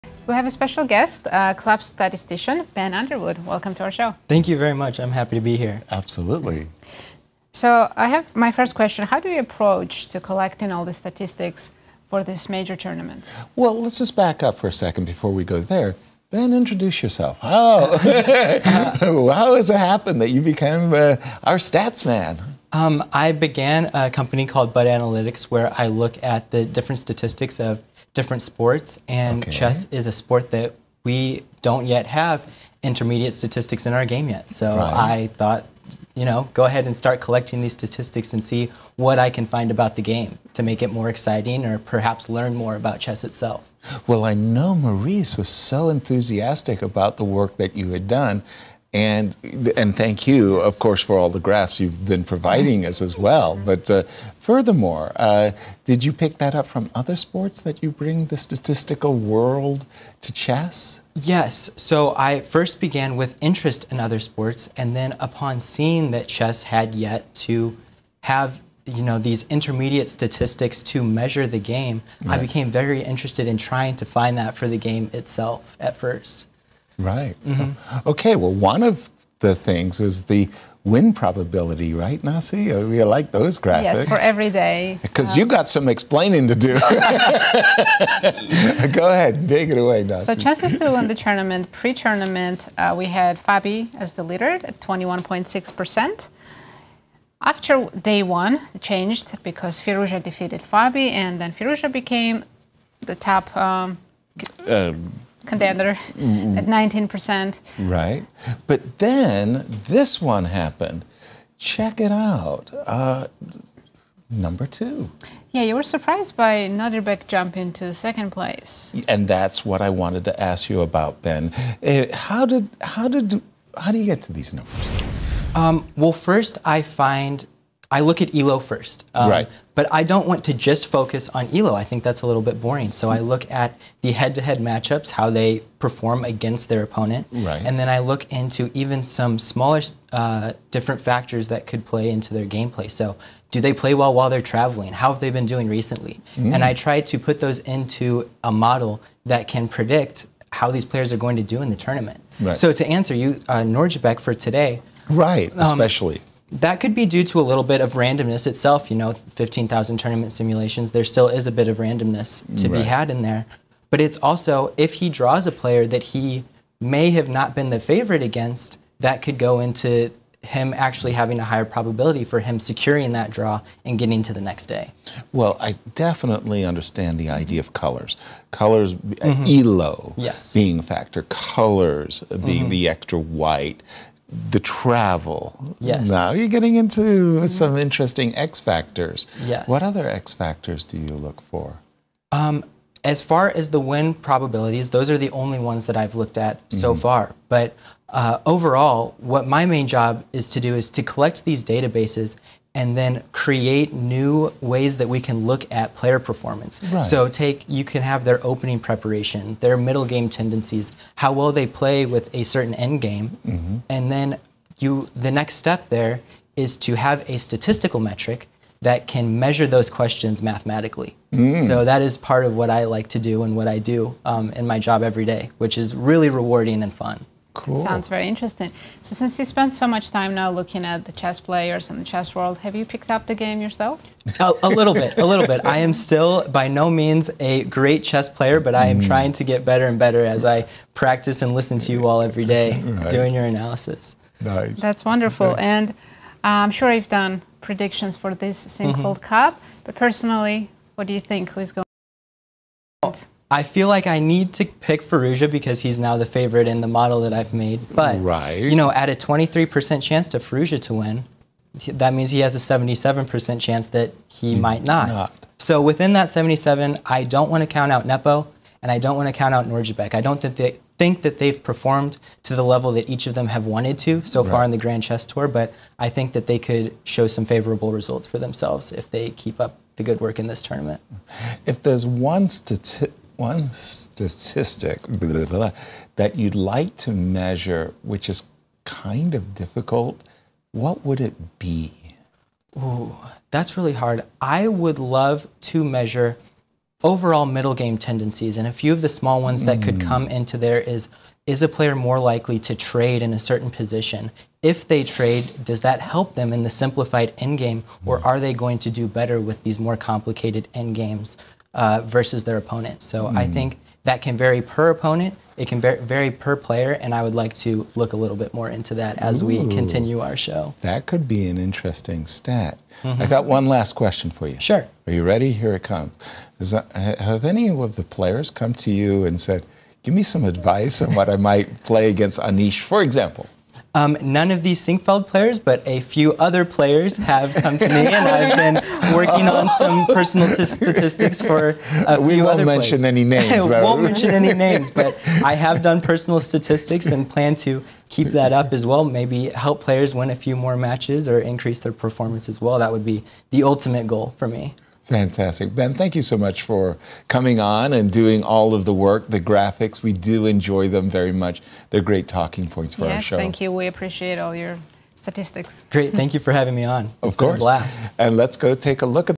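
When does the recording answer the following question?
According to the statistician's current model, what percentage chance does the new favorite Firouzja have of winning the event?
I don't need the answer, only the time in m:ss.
4:19.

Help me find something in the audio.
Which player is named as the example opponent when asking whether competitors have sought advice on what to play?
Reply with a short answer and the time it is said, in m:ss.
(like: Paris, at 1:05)
Anish, at 5:32.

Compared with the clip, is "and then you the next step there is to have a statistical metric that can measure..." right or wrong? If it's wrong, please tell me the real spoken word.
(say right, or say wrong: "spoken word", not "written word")
right.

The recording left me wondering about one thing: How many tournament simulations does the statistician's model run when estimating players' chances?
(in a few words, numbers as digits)
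15,000.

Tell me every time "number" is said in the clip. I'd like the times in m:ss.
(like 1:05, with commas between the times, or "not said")
1:54, 2:04.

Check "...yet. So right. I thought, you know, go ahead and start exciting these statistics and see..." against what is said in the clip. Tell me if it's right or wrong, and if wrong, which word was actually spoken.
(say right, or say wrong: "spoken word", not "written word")
wrong: "collecting", not "exciting".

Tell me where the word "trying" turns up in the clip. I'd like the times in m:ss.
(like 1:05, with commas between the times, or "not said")
1:13, 3:59.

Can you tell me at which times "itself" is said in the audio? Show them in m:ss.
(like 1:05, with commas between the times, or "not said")
0:43, 1:15, 2:38.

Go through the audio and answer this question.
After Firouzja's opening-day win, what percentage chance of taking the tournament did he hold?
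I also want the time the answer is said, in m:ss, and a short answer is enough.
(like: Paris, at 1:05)
19%, at 1:46.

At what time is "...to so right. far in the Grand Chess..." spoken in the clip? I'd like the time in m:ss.
4:33.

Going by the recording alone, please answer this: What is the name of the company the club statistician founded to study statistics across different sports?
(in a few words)
Bud Analytics.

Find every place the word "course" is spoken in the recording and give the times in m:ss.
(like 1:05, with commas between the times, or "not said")
0:50, 6:07.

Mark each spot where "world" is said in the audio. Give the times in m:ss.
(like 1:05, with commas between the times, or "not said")
0:59, 3:52.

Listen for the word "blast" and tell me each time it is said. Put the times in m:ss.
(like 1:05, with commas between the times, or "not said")
6:07.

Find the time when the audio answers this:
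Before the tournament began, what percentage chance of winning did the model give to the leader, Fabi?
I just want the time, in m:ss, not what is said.
1:34.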